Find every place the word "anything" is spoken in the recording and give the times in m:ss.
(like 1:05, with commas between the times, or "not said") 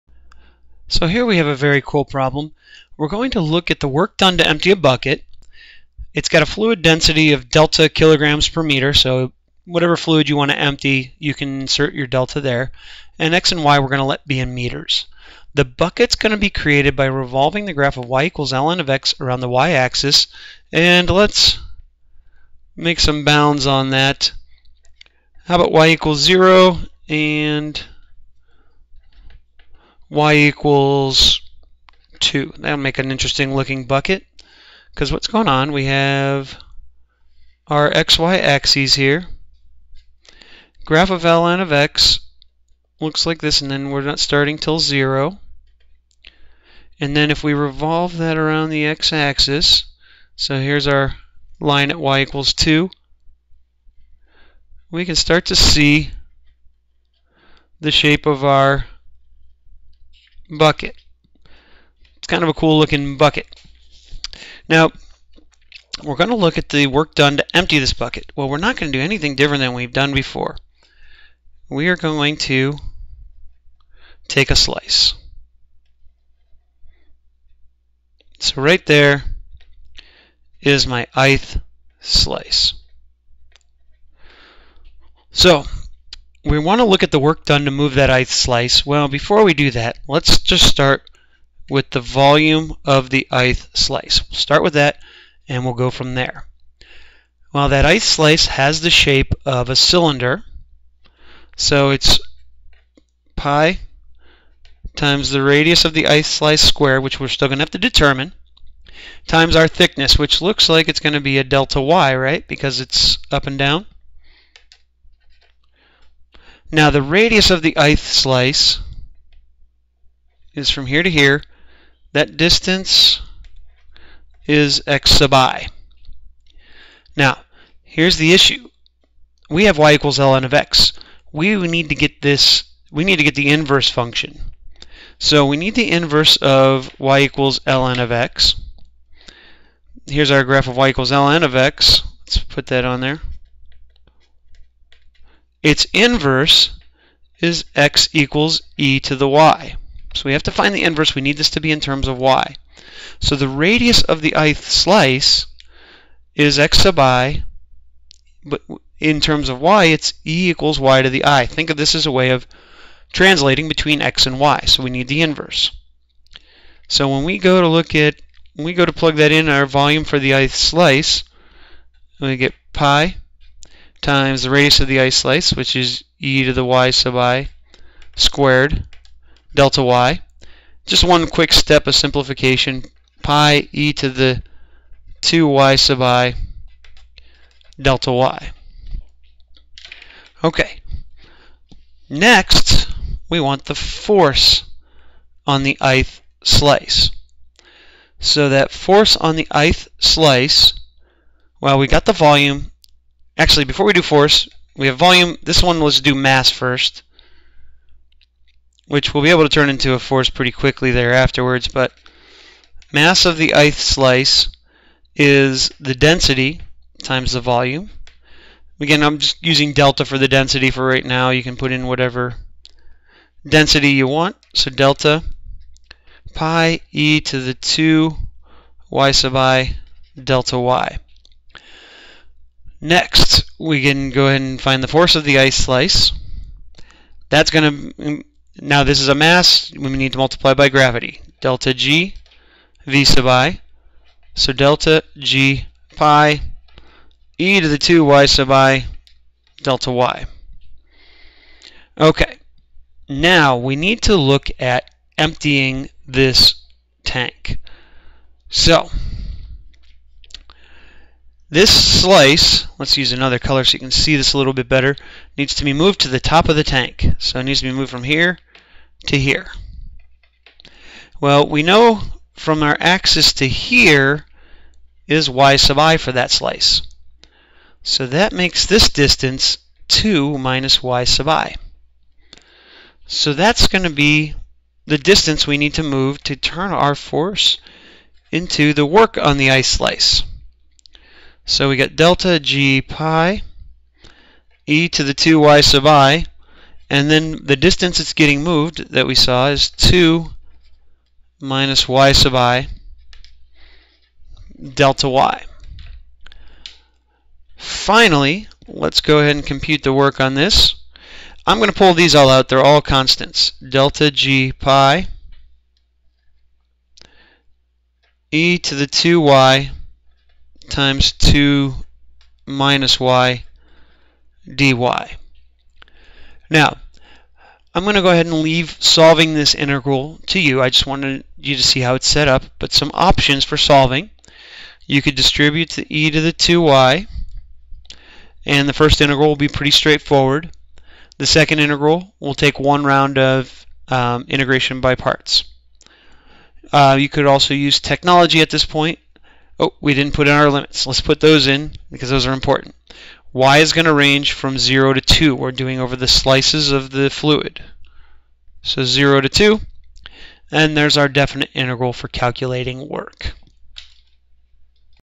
1:09.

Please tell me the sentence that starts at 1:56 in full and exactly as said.
Now the radius of the ith slice is from here to here.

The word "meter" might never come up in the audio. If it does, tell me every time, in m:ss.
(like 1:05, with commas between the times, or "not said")
0:08, 0:14.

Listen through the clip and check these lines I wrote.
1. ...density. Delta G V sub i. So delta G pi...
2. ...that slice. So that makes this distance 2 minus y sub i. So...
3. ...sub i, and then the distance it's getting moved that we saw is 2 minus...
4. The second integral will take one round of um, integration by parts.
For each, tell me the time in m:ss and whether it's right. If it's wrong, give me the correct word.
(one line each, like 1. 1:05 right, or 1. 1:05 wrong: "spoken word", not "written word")
1. 4:00 wrong: "gravity", not "density"
2. 4:36 right
3. 4:55 right
4. 5:41 right.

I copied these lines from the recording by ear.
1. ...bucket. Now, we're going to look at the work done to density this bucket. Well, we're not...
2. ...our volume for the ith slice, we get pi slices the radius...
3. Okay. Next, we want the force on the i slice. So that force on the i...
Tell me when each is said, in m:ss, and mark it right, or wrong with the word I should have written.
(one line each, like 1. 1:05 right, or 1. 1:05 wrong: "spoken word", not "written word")
1. 1:03 wrong: "empty", not "density"
2. 2:49 wrong: "times", not "slices"
3. 3:10 right.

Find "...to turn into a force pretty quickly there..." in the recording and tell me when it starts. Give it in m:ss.
3:29.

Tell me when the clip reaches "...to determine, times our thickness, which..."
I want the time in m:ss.
1:47.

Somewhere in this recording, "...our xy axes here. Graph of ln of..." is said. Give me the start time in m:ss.
0:37.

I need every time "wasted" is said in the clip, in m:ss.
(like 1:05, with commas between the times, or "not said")
not said.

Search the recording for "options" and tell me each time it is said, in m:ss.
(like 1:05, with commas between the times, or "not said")
5:32.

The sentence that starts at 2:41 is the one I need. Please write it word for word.
Think of this as a way of translating between x and y.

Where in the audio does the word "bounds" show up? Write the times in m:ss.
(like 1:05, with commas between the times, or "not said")
0:23.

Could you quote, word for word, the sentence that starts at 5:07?
Finally, let's go ahead and compute the work on this.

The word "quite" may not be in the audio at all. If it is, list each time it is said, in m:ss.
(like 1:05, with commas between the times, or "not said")
not said.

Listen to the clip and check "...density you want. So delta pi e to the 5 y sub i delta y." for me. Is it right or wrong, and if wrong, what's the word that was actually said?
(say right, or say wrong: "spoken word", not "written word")
wrong: "2", not "5".